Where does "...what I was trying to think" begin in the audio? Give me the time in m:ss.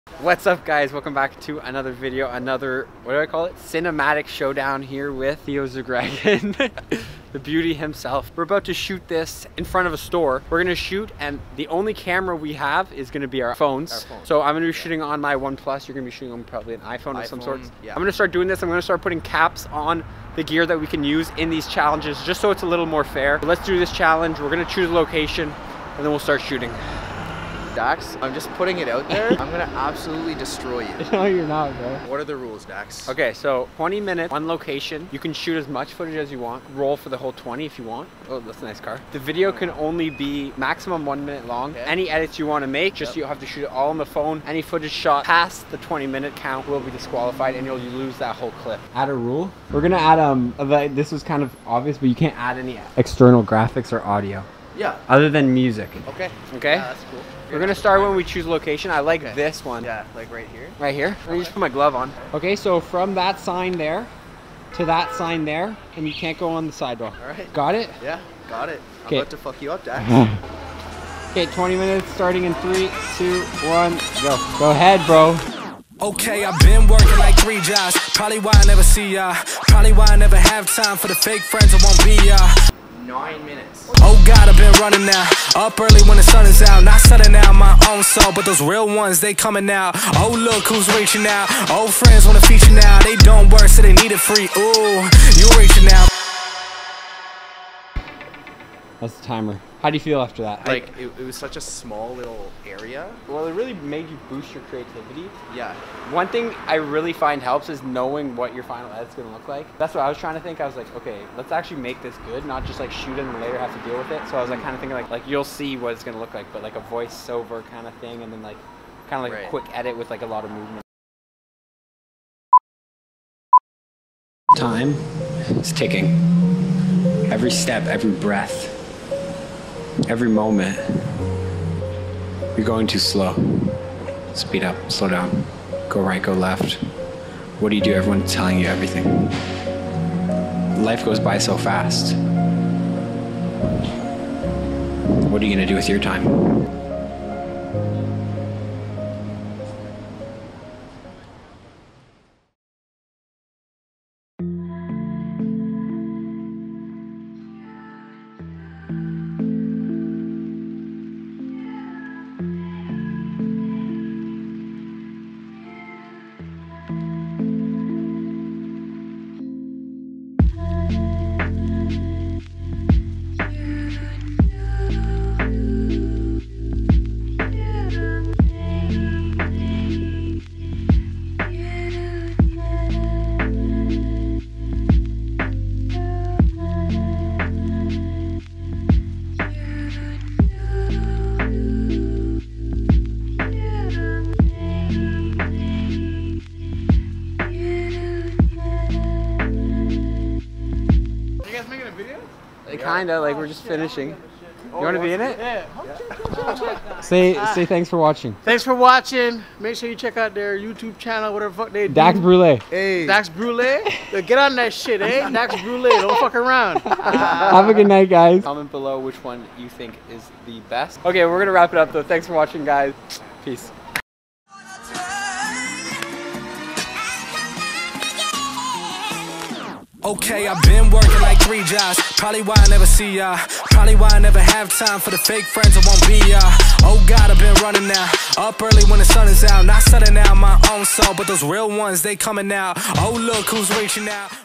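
1:49.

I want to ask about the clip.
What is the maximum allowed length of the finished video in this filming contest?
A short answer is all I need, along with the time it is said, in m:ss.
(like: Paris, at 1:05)
1 minute, at 0:41.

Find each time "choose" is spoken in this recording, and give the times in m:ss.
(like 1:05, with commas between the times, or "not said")
0:24, 0:58.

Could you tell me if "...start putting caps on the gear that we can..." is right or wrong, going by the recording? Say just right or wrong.
right.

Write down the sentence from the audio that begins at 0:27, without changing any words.
Dax, I'm just putting it out there.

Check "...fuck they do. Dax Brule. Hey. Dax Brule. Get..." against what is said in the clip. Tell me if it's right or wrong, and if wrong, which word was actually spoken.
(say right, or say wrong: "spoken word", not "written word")
right.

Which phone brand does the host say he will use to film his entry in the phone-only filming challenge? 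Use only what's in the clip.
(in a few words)
OnePlus.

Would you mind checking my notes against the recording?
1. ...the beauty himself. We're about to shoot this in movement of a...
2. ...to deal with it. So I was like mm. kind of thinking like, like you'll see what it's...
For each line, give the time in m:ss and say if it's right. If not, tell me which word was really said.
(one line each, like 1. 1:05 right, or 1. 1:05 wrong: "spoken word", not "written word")
1. 0:07 wrong: "front", not "movement"
2. 1:53 right.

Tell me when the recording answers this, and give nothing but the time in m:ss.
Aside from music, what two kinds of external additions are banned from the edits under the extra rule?
0:53.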